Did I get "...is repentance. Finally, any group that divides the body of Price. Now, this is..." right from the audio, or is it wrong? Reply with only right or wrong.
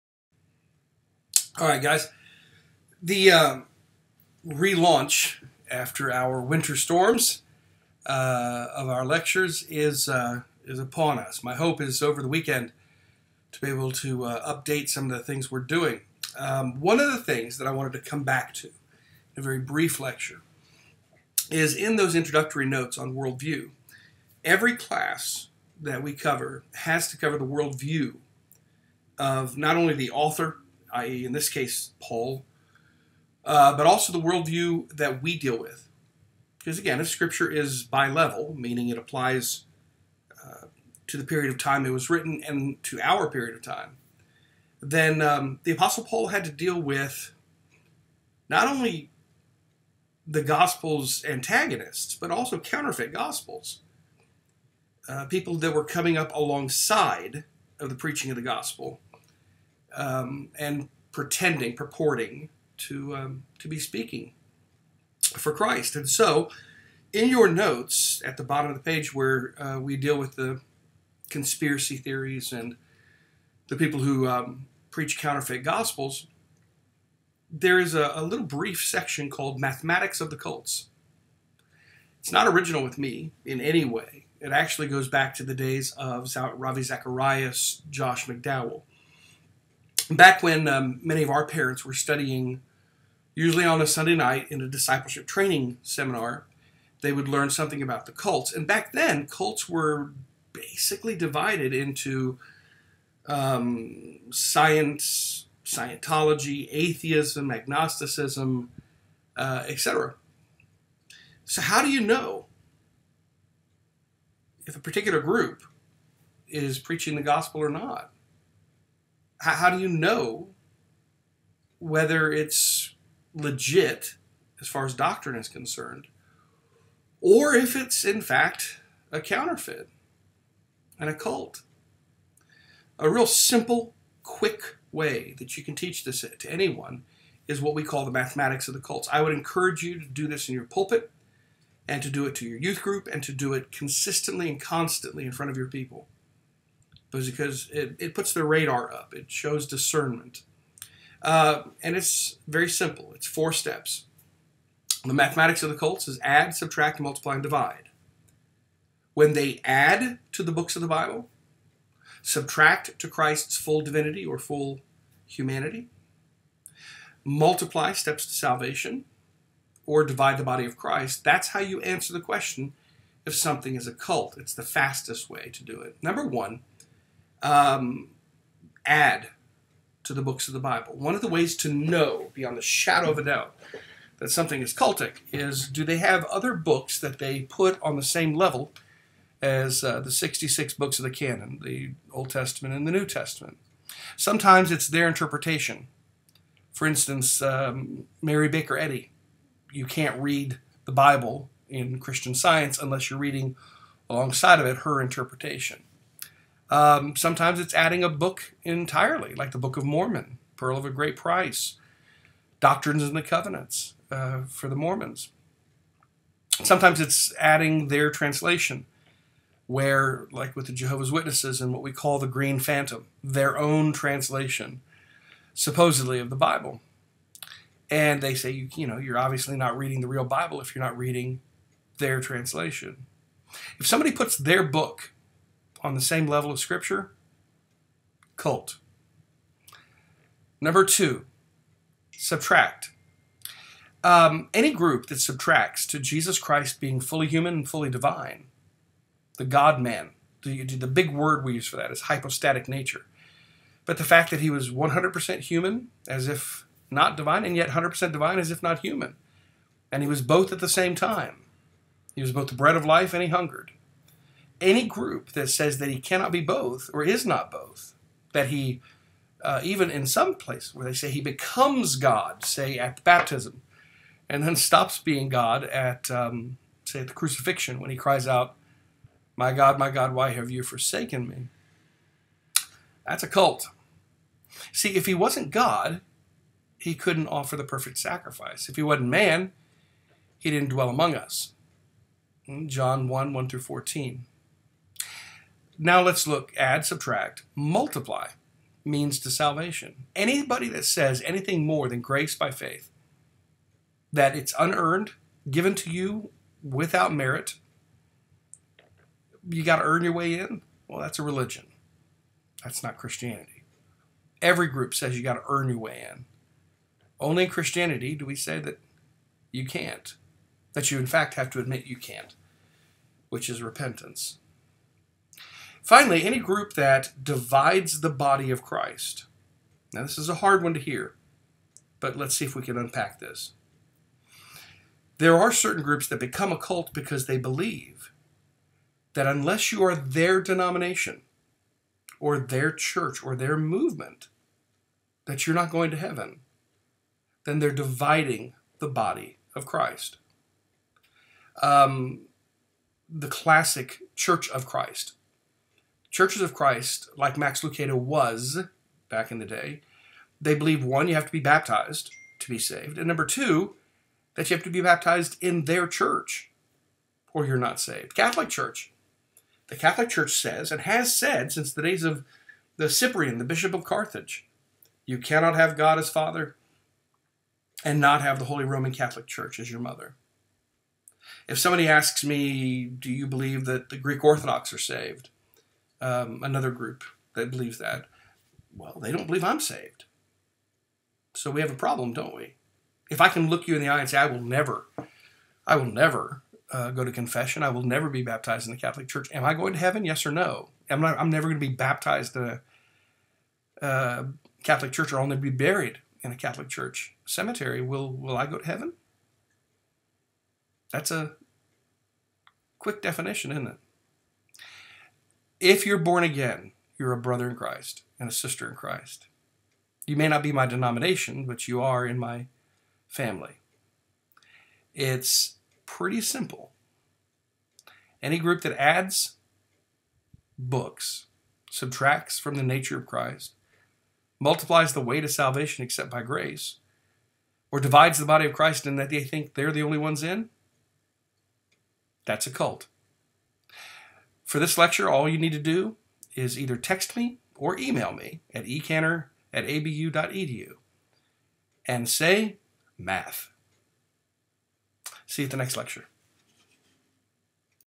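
wrong.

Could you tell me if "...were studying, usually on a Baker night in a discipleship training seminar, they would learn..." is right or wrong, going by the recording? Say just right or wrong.
wrong.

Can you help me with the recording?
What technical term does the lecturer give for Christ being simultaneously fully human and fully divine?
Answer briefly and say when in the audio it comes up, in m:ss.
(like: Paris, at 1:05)
hypostatic nature, at 4:12.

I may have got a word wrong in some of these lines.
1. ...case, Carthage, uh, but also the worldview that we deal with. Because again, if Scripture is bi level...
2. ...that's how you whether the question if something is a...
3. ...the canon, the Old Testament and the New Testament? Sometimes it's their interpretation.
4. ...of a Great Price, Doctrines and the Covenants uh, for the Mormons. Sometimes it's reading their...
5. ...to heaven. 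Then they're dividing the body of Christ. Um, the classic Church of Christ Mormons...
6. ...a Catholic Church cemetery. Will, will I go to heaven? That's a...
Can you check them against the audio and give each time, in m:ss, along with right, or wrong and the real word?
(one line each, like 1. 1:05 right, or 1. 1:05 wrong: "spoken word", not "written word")
1. 0:31 wrong: "Paul", not "Carthage"
2. 2:51 wrong: "answer", not "whether"
3. 3:11 right
4. 3:30 wrong: "adding", not "reading"
5. 5:45 wrong: "Churches", not "Mormons"
6. 6:46 right.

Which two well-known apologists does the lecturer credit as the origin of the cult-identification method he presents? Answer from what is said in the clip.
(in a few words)
Ravi Zacharias, Josh McDowell.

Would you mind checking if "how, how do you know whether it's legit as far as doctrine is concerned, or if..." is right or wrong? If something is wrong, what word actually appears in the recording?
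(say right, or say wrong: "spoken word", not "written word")
right.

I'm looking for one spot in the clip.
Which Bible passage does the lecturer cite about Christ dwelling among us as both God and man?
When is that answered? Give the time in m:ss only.
4:52.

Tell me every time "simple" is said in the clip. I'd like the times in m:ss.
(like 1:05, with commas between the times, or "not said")
2:13, 2:32, 7:06.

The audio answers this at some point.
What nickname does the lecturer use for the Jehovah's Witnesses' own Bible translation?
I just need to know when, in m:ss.
3:42.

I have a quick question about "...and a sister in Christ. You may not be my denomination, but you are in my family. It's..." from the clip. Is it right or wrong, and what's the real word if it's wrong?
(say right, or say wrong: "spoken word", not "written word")
right.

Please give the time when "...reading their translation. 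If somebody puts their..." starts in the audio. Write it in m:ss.
3:50.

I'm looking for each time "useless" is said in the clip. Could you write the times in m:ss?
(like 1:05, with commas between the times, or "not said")
not said.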